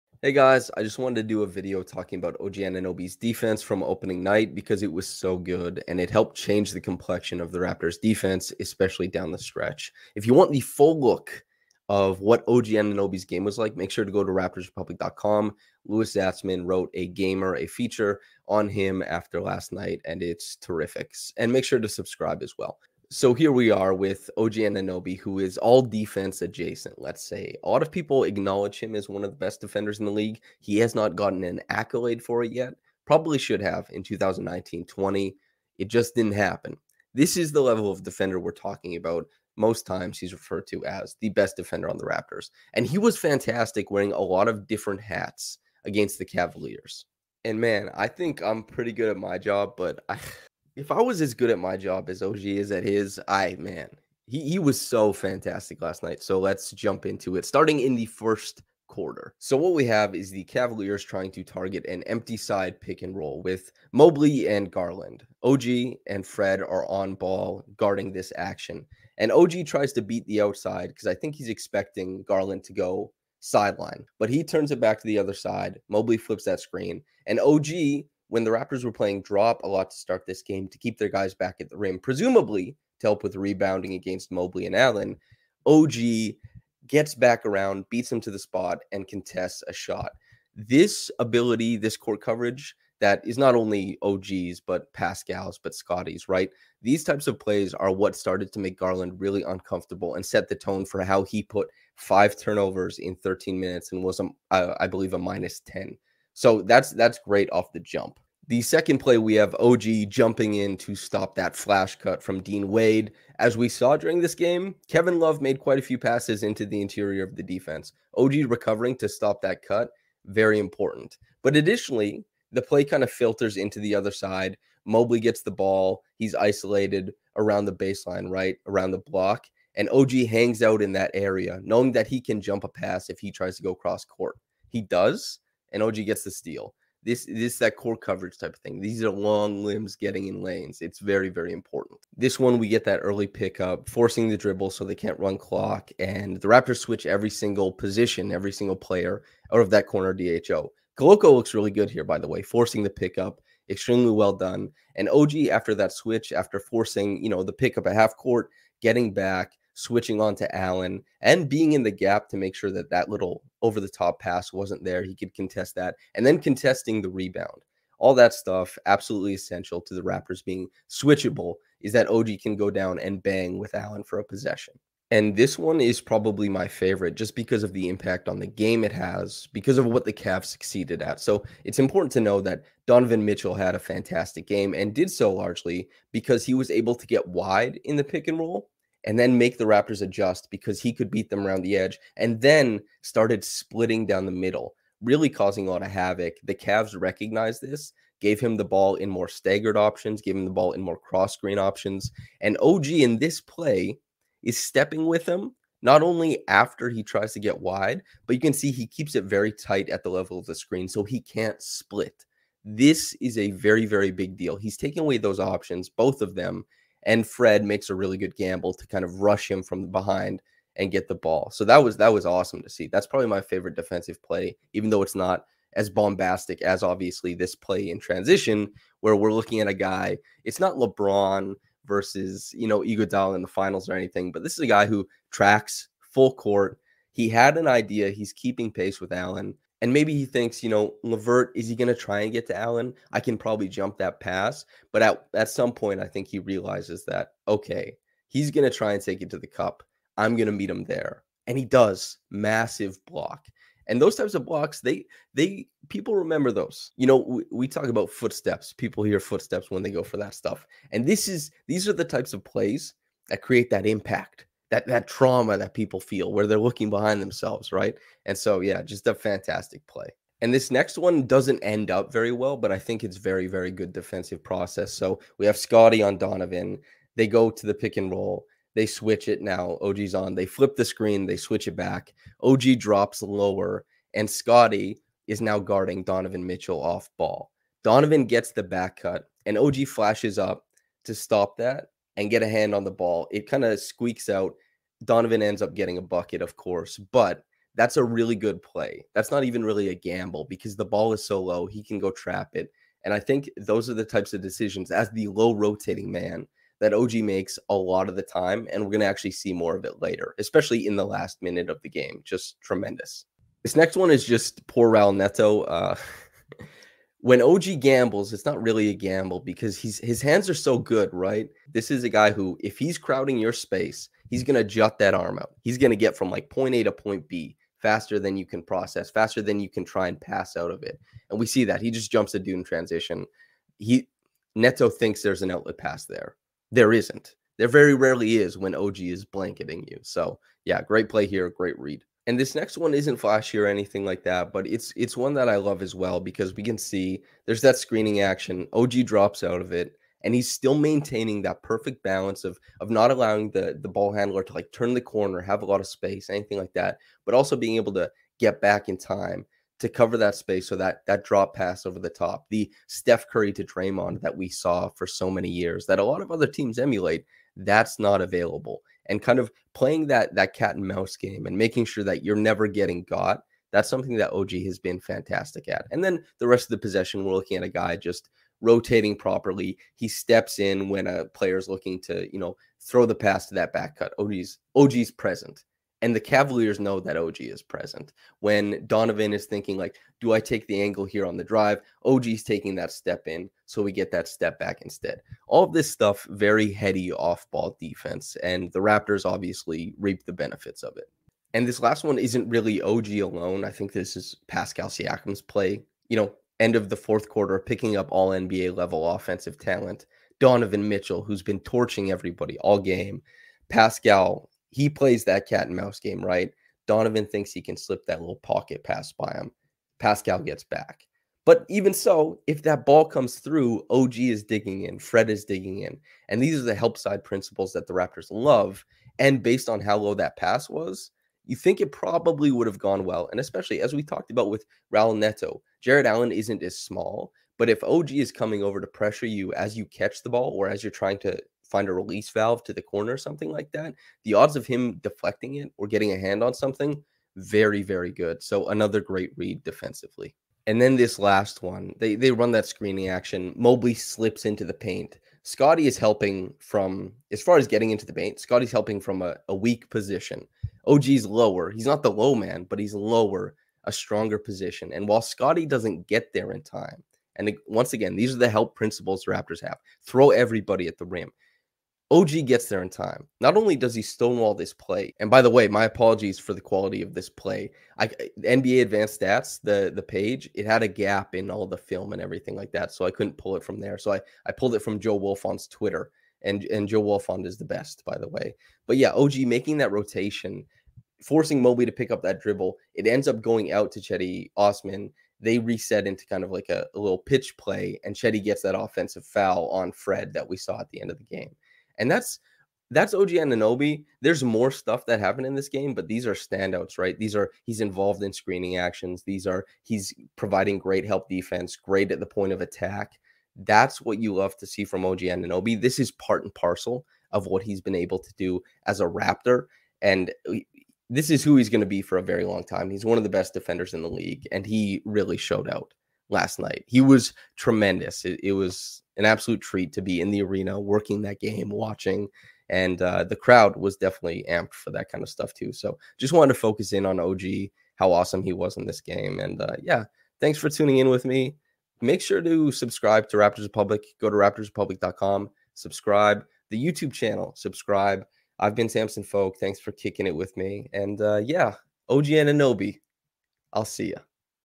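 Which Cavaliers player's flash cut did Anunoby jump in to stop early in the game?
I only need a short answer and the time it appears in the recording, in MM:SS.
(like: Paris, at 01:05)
Dean Wade, at 01:52.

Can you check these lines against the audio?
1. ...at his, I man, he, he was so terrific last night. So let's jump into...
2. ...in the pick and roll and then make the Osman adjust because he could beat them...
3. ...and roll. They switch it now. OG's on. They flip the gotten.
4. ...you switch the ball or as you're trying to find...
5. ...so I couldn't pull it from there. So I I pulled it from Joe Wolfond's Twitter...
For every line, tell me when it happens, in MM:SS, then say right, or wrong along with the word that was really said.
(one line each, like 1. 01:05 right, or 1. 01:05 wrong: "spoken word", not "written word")
1. 00:52 wrong: "fantastic", not "terrific"
2. 03:07 wrong: "Raptors", not "Osman"
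3. 04:37 wrong: "screen", not "gotten"
4. 07:19 wrong: "catch", not "switch"
5. 08:02 right.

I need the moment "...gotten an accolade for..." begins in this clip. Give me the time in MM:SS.
00:31.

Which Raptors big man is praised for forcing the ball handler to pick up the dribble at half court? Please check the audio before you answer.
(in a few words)
Koloko.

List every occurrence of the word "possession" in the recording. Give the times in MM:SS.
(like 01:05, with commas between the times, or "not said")
02:54, 06:16.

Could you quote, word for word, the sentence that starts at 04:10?
I'm going to meet him there.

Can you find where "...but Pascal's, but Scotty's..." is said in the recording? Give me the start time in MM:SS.
01:34.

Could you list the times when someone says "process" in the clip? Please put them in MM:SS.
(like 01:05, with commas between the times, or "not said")
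04:34, 05:28.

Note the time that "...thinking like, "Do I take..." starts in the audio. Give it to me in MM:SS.
06:29.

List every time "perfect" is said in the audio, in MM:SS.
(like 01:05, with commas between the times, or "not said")
05:51.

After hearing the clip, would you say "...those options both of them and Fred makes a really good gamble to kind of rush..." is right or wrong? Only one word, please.
right.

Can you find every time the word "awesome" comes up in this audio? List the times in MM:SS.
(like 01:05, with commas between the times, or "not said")
03:42, 08:58.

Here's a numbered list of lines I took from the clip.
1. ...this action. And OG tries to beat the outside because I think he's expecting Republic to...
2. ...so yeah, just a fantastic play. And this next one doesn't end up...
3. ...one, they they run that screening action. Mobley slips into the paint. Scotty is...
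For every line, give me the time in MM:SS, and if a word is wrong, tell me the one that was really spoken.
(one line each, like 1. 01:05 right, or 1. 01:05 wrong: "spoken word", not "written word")
1. 01:08 wrong: "Garland", not "Republic"
2. 04:28 right
3. 07:31 right.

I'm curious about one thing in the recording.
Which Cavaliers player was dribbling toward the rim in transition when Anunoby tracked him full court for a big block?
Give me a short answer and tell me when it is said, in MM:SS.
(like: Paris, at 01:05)
LeVert, at 04:01.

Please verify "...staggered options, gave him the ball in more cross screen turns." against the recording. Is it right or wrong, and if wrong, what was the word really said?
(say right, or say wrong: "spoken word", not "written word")
wrong: "options", not "turns".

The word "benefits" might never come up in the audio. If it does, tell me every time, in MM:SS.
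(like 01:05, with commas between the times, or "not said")
06:40.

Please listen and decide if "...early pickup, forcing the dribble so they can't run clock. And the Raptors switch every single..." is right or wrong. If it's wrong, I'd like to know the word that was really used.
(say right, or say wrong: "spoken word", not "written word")
right.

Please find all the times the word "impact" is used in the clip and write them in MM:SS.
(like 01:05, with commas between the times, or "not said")
02:57, 04:23.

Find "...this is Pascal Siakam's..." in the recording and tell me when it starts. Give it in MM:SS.
06:43.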